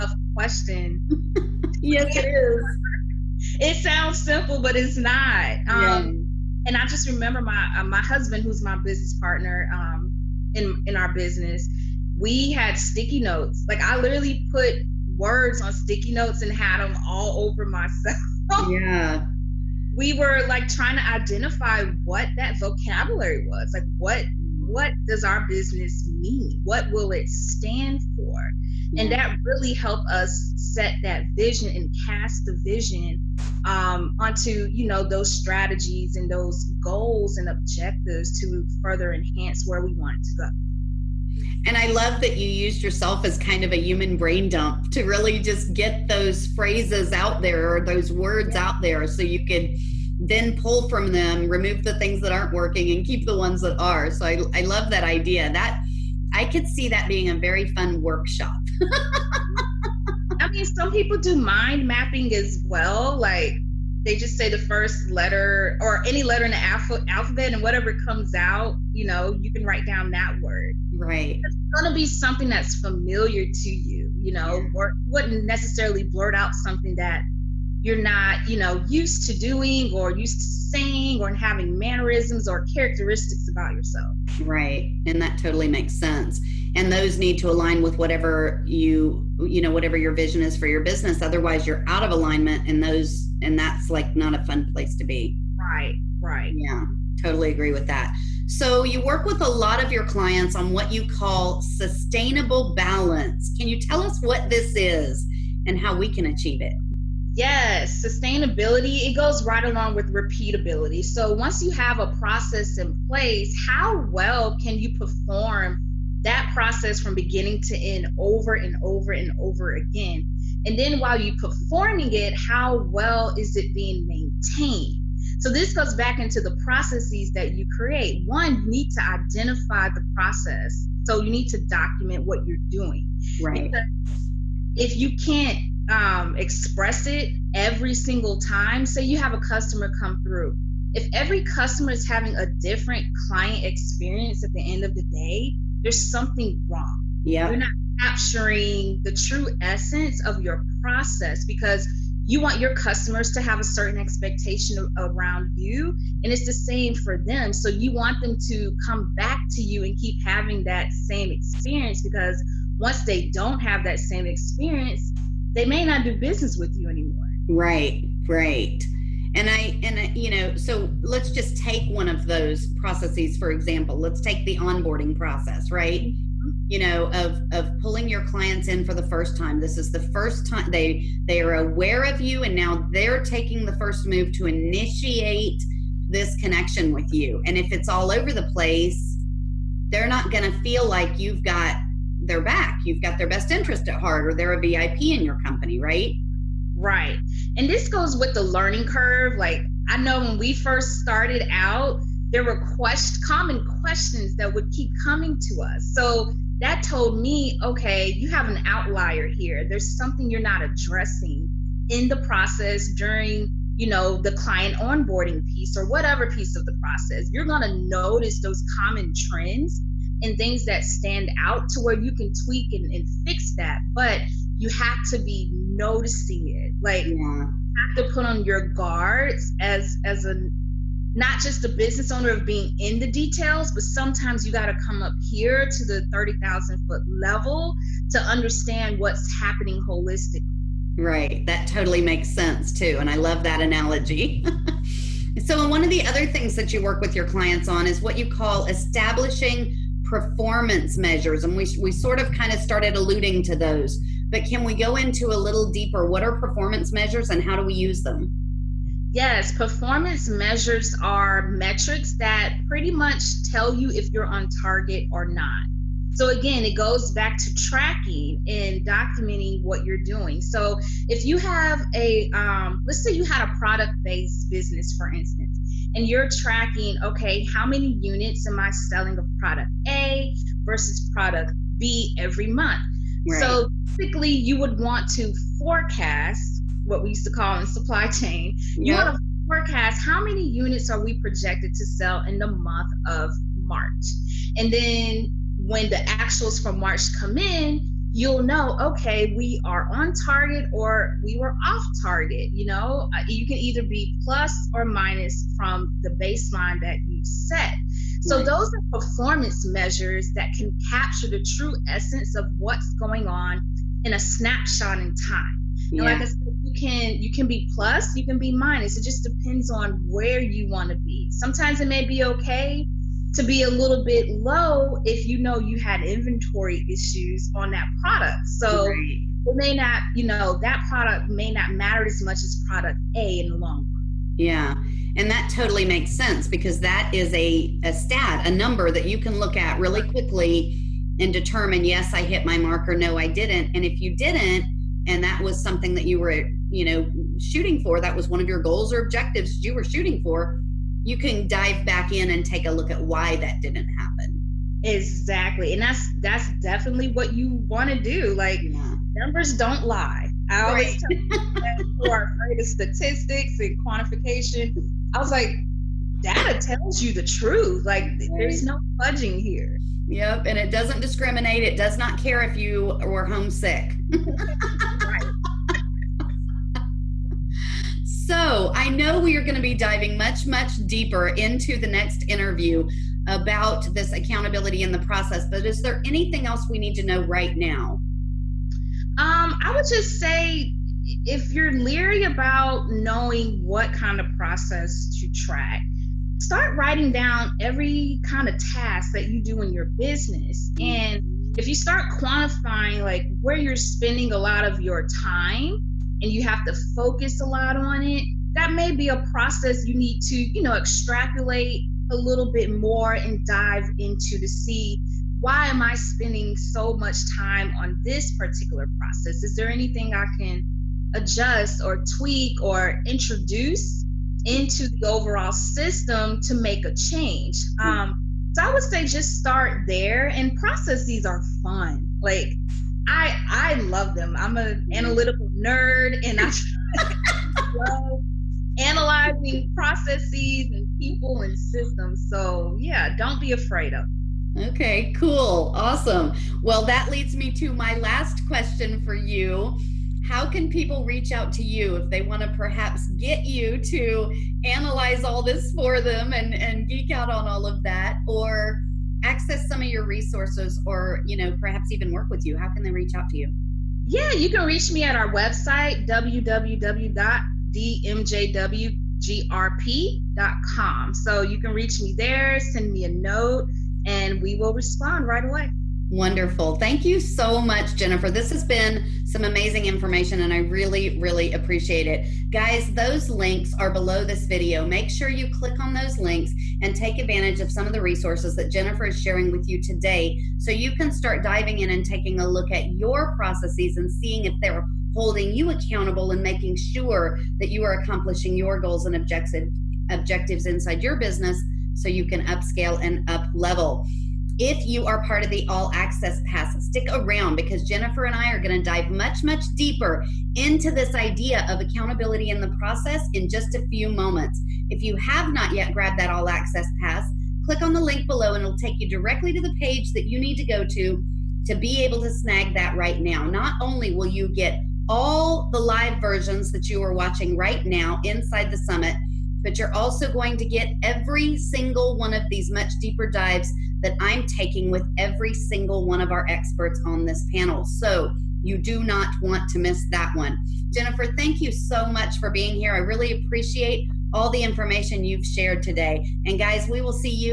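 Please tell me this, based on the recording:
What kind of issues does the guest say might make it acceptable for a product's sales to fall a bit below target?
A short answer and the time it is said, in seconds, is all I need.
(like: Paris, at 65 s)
inventory issues, at 326 s.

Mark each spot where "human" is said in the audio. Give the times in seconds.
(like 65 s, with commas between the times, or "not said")
43 s.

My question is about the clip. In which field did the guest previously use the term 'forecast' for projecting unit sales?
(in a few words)
supply chain.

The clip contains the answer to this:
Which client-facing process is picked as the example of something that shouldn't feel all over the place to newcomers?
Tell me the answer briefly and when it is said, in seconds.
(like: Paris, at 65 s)
onboarding process, at 174 s.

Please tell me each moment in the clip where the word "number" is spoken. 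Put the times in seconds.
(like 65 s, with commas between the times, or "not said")
338 s, 359 s.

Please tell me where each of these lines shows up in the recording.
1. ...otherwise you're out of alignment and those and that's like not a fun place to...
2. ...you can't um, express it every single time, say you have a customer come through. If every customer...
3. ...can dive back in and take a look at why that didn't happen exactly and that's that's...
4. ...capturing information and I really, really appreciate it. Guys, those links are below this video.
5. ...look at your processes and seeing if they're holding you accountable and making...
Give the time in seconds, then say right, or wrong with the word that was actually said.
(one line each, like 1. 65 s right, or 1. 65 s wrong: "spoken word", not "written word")
1. 91 s right
2. 134 s right
3. 351 s right
4. 479 s wrong: "amazing", not "capturing"
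5. 492 s right.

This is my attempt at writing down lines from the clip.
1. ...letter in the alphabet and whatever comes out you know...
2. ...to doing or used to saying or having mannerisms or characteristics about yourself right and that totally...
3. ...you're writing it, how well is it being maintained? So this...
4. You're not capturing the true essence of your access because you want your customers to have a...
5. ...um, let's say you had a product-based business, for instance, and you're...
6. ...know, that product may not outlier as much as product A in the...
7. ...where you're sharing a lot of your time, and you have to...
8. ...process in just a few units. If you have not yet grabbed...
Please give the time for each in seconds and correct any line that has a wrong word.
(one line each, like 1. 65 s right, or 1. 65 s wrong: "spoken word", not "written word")
1. 66 s right
2. 79 s right
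3. 121 s wrong: "performing", not "writing"
4. 147 s wrong: "process", not "access"
5. 272 s right
6. 330 s wrong: "matter", not "outlier"
7. 403 s wrong: "spending", not "sharing"
8. 512 s wrong: "moments", not "units".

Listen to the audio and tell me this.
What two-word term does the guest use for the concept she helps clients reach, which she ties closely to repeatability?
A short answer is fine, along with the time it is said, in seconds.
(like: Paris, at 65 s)
sustainable balance, at 101 s.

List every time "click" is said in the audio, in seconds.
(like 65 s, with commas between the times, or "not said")
485 s, 517 s.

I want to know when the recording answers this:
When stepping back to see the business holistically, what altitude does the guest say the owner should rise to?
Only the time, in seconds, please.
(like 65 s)
236 s.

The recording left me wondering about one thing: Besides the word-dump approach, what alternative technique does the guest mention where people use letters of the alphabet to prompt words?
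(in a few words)
mind mapping.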